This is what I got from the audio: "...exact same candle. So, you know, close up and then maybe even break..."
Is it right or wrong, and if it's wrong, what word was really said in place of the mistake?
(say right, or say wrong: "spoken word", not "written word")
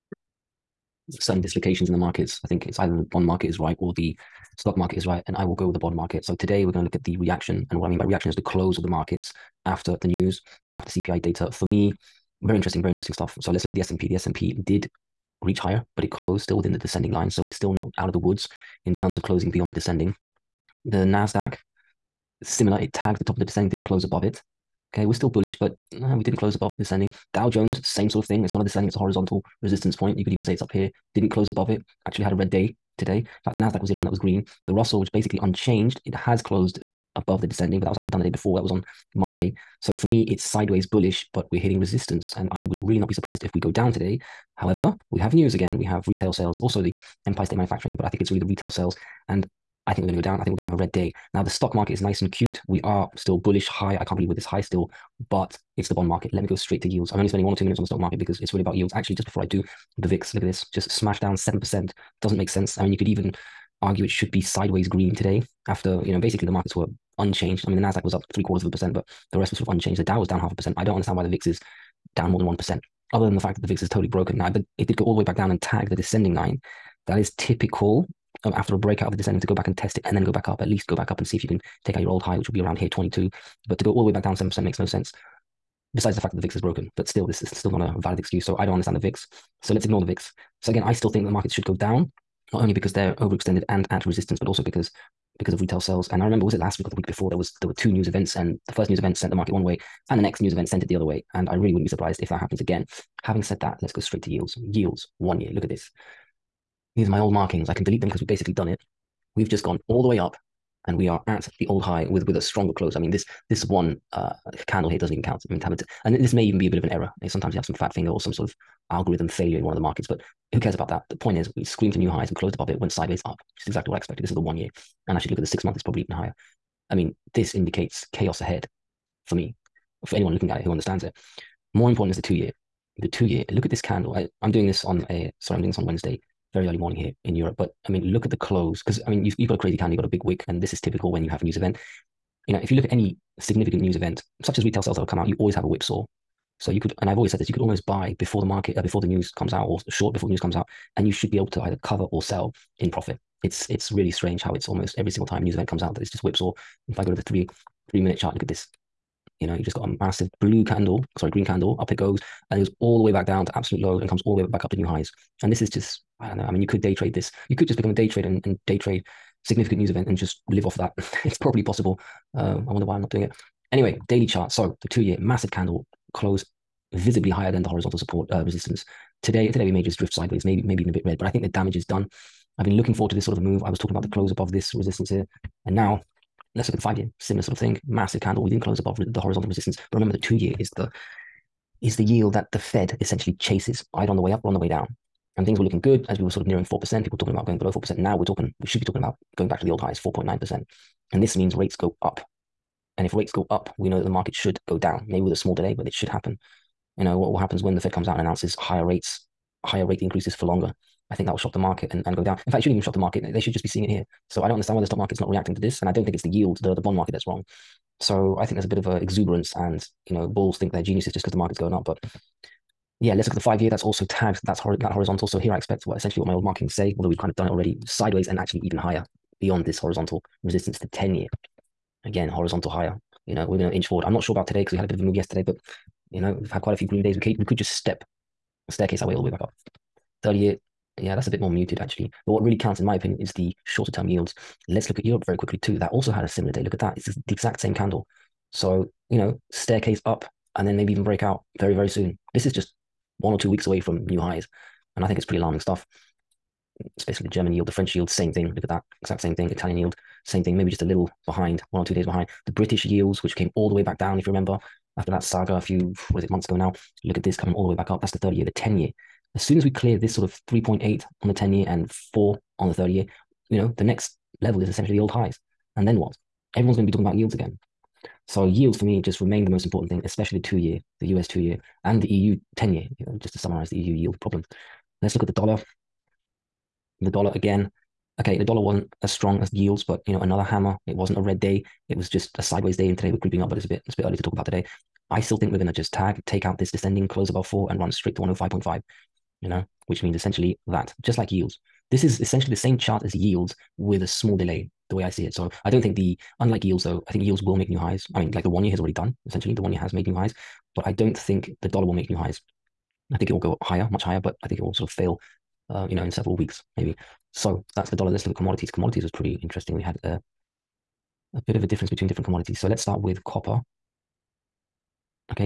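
wrong: "staircase", not "close".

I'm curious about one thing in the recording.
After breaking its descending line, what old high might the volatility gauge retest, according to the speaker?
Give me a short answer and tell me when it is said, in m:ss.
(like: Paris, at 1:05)
22, at 1:22.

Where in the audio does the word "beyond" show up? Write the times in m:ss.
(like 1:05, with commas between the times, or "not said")
0:19, 3:49.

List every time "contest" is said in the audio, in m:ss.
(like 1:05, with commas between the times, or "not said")
not said.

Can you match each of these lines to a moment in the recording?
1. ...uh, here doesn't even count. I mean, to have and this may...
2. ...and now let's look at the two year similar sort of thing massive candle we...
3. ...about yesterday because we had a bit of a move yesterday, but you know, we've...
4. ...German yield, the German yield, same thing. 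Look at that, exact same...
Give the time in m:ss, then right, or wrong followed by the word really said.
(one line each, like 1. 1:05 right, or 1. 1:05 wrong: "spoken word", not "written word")
1. 1:54 right
2. 3:05 wrong: "five", not "two"
3. 3:54 wrong: "today", not "yesterday"
4. 4:17 wrong: "French", not "German".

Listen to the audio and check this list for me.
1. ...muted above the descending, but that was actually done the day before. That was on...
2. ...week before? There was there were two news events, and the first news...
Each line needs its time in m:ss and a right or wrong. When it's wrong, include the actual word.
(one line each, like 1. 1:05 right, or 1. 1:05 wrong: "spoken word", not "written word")
1. 0:36 wrong: "closed", not "muted"
2. 1:36 right.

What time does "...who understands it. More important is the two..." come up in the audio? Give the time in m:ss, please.
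2:10.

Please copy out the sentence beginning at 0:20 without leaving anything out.
The NASDAQ, similar, it tagged the top of the descending, didn't close above it.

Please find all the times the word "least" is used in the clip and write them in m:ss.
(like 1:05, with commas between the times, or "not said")
1:20.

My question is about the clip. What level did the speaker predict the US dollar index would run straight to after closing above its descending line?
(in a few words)
105.5.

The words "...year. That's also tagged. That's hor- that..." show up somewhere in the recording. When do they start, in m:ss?
3:43.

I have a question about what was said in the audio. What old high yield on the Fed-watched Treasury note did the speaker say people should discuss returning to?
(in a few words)
4.9%.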